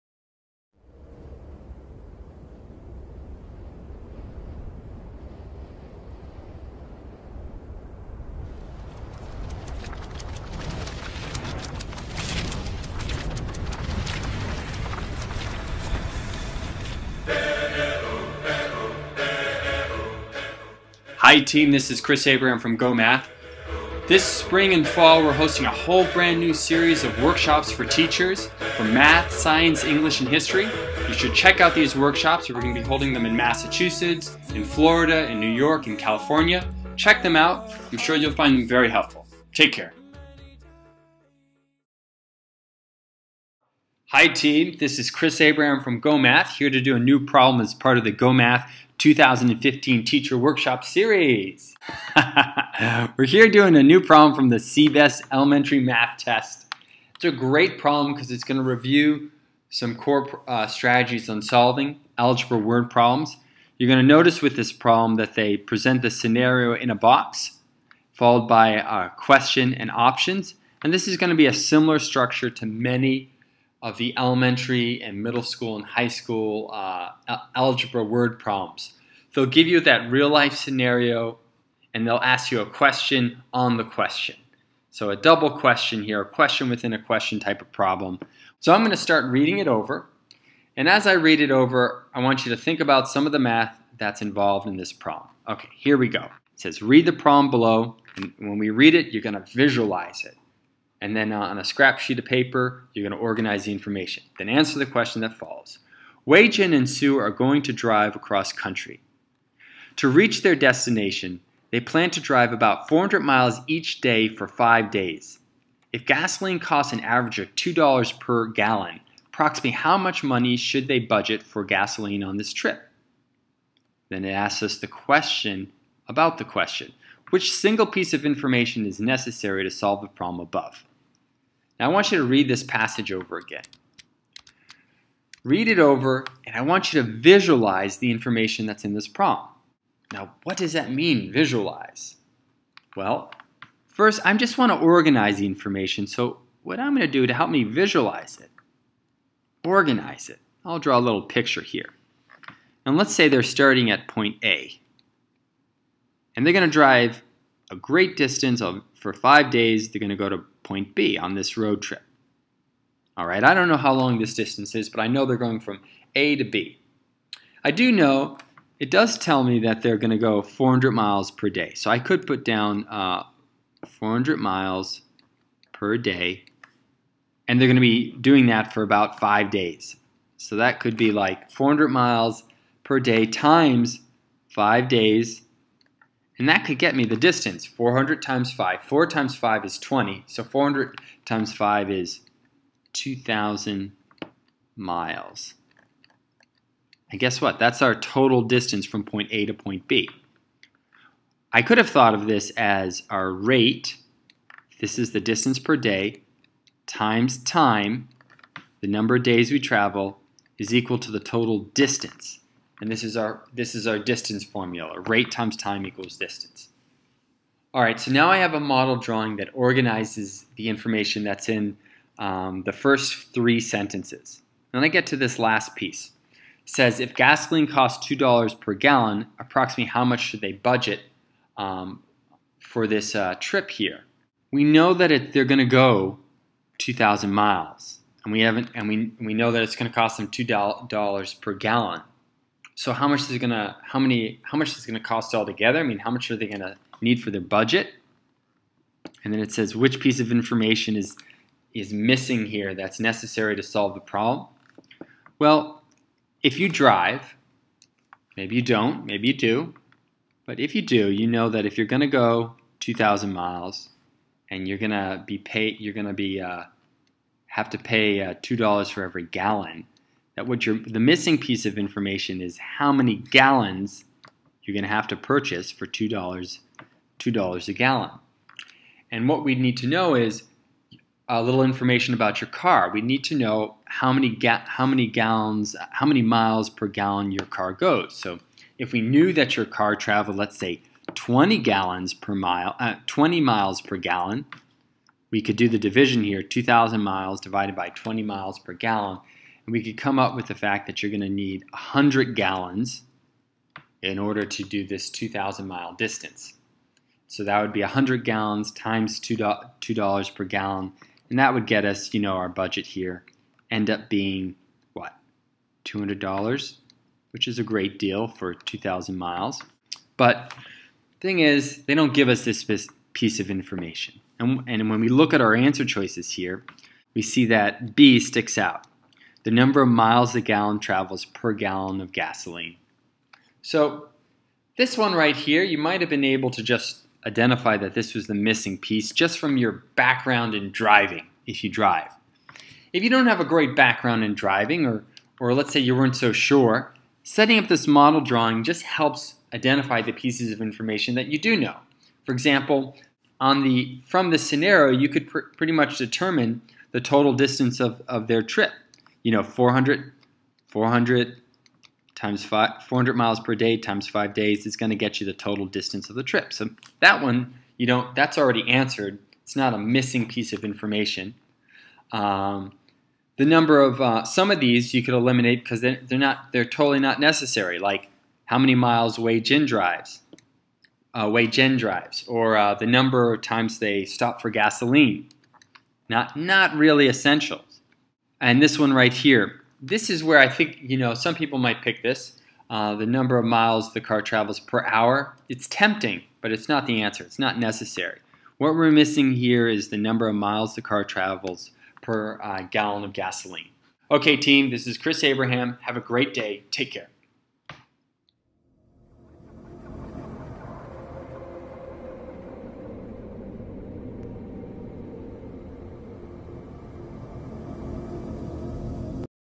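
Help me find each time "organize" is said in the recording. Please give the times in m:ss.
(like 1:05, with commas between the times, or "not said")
1:43, 2:24, 2:29, 3:39.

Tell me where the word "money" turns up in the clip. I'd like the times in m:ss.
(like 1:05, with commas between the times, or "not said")
2:00.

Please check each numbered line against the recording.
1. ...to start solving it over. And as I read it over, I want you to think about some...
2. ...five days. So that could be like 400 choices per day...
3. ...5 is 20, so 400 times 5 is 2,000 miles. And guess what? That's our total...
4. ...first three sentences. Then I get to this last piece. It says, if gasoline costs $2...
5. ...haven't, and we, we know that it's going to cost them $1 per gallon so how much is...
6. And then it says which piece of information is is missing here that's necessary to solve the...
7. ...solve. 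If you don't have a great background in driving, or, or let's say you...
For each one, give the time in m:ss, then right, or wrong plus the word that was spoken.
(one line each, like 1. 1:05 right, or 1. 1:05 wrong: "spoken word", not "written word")
1. 1:28 wrong: "reading", not "solving"
2. 2:59 wrong: "miles", not "choices"
3. 3:09 right
4. 3:42 right
5. 3:58 wrong: "2", not "1"
6. 4:09 right
7. 5:41 wrong: "drive", not "solve".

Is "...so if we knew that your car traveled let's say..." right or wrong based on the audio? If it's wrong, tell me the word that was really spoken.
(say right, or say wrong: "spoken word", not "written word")
right.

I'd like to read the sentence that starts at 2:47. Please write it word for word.
I do know it does tell me that they're going to go 400 miles per day.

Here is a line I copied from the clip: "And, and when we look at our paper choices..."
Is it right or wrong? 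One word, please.
wrong.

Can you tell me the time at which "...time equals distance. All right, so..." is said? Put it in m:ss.
3:35.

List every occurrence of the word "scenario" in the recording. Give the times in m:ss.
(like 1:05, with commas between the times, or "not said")
1:06, 1:20, 5:54.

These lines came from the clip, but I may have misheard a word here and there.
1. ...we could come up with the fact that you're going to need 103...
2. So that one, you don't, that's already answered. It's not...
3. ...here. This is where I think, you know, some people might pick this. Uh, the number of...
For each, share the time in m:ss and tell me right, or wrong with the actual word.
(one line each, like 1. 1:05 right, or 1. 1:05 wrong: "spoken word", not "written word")
1. 4:59 wrong: "100", not "103"
2. 6:06 right
3. 6:29 right.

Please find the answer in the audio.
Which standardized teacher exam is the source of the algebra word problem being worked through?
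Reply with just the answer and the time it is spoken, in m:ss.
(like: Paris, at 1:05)
CBEST Elementary Math Test, at 0:54.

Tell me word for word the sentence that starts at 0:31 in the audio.
You should check out these workshops.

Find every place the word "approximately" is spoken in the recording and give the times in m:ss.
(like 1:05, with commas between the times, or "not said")
1:59, 3:49.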